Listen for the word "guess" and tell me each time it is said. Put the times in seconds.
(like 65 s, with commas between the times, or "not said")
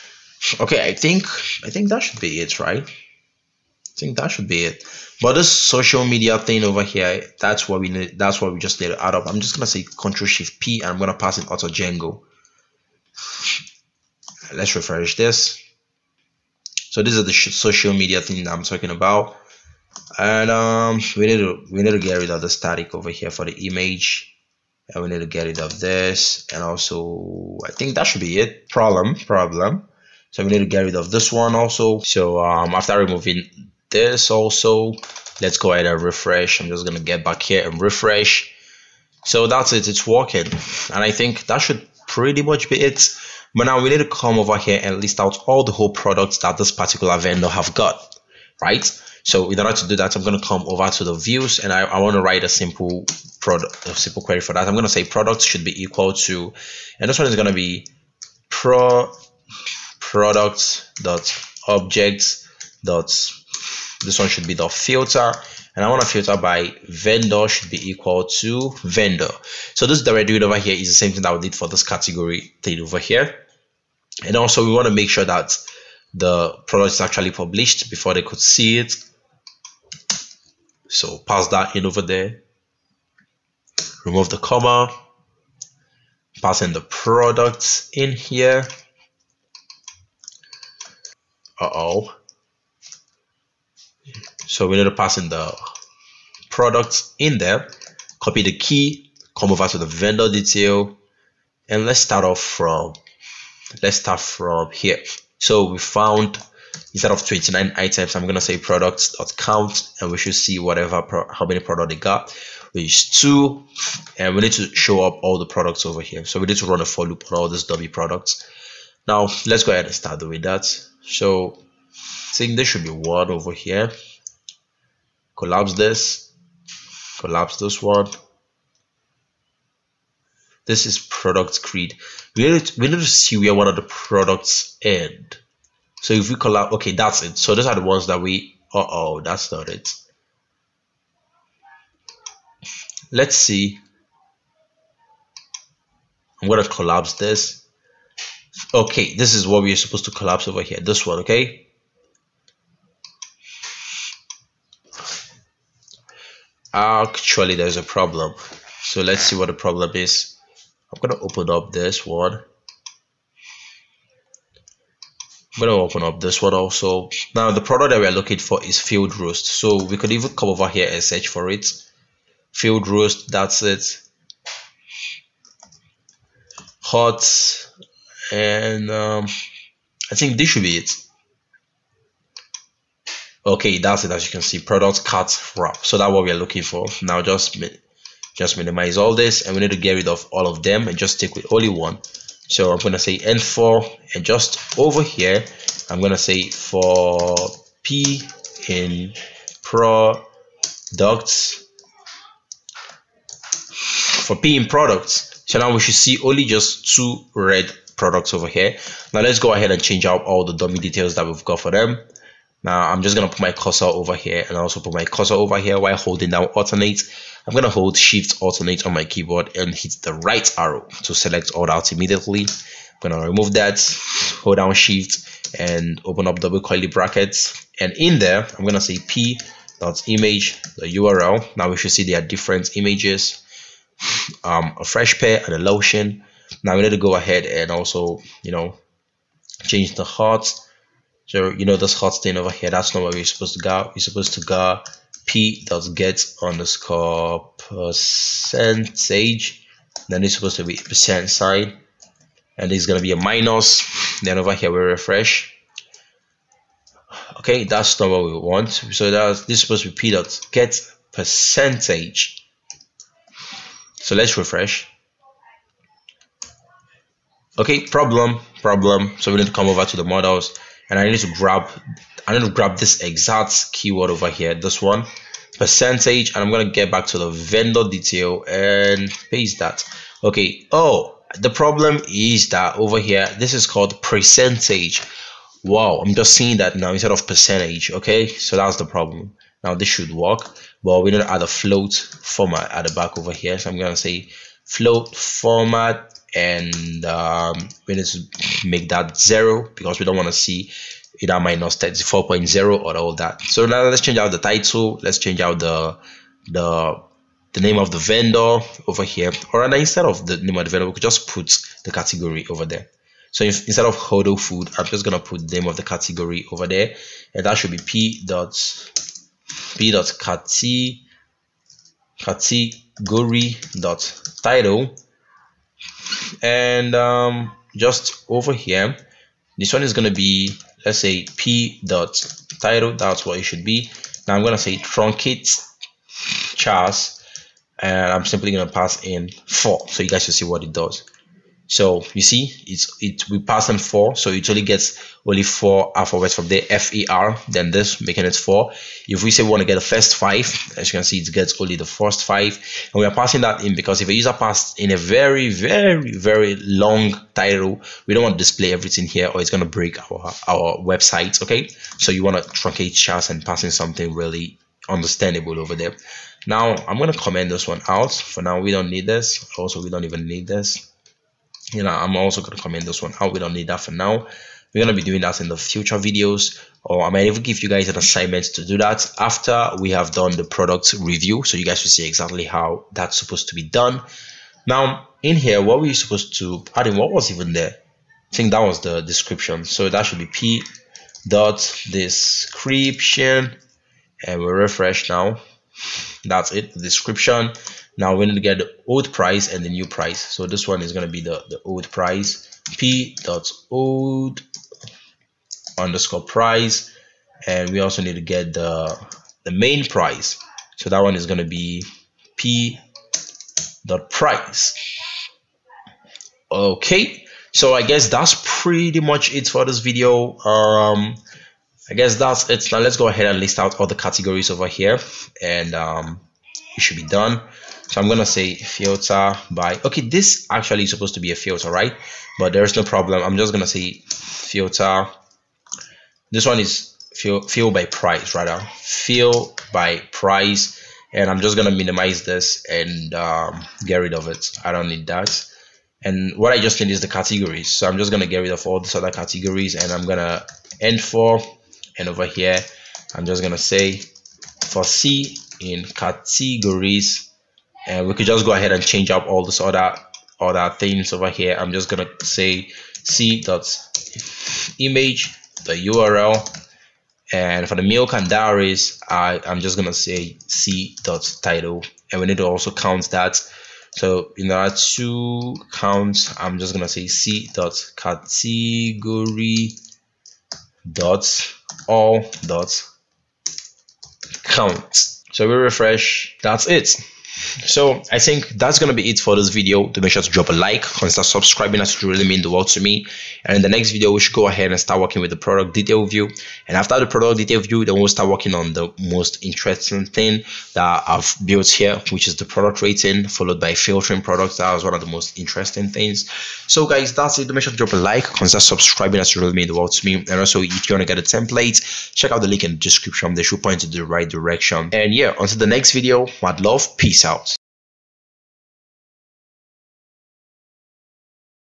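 417 s, 421 s.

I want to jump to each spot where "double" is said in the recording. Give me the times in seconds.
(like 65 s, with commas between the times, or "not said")
226 s.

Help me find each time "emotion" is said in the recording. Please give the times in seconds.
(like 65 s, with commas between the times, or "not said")
not said.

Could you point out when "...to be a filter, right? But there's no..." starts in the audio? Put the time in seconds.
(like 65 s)
431 s.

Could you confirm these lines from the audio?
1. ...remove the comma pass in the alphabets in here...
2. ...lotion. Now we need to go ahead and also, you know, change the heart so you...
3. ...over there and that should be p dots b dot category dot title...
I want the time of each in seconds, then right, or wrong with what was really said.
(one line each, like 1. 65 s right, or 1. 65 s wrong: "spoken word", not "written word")
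1. 84 s wrong: "products", not "alphabets"
2. 235 s right
3. 316 s right.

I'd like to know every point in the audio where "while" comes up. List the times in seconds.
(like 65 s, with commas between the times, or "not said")
215 s.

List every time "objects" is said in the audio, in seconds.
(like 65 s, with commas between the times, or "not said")
61 s.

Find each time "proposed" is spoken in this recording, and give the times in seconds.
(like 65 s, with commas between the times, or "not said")
not said.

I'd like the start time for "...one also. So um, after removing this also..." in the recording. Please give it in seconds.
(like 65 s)
31 s.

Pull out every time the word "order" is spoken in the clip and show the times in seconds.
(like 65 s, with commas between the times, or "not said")
49 s, 474 s.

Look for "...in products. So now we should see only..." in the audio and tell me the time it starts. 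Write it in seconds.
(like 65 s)
204 s.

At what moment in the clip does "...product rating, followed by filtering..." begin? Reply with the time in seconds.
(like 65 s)
502 s.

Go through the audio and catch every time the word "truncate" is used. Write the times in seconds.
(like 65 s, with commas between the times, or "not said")
334 s, 362 s.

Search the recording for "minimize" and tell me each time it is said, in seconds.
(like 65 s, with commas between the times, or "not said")
188 s, 441 s.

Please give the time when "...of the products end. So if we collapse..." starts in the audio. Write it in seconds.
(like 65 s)
133 s.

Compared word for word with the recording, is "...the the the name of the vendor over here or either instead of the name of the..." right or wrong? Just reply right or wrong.
wrong.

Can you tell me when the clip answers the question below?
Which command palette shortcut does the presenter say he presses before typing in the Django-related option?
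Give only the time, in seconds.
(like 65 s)
9 s.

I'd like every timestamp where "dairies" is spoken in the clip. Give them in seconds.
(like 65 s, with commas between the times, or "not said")
468 s.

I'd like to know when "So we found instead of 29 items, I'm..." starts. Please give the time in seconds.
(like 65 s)
105 s.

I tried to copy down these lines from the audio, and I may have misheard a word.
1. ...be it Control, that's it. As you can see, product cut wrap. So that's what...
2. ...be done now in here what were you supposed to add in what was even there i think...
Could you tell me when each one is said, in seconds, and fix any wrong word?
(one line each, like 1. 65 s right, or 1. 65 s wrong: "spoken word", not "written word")
1. 180 s wrong: "Okay", not "Control"
2. 383 s right.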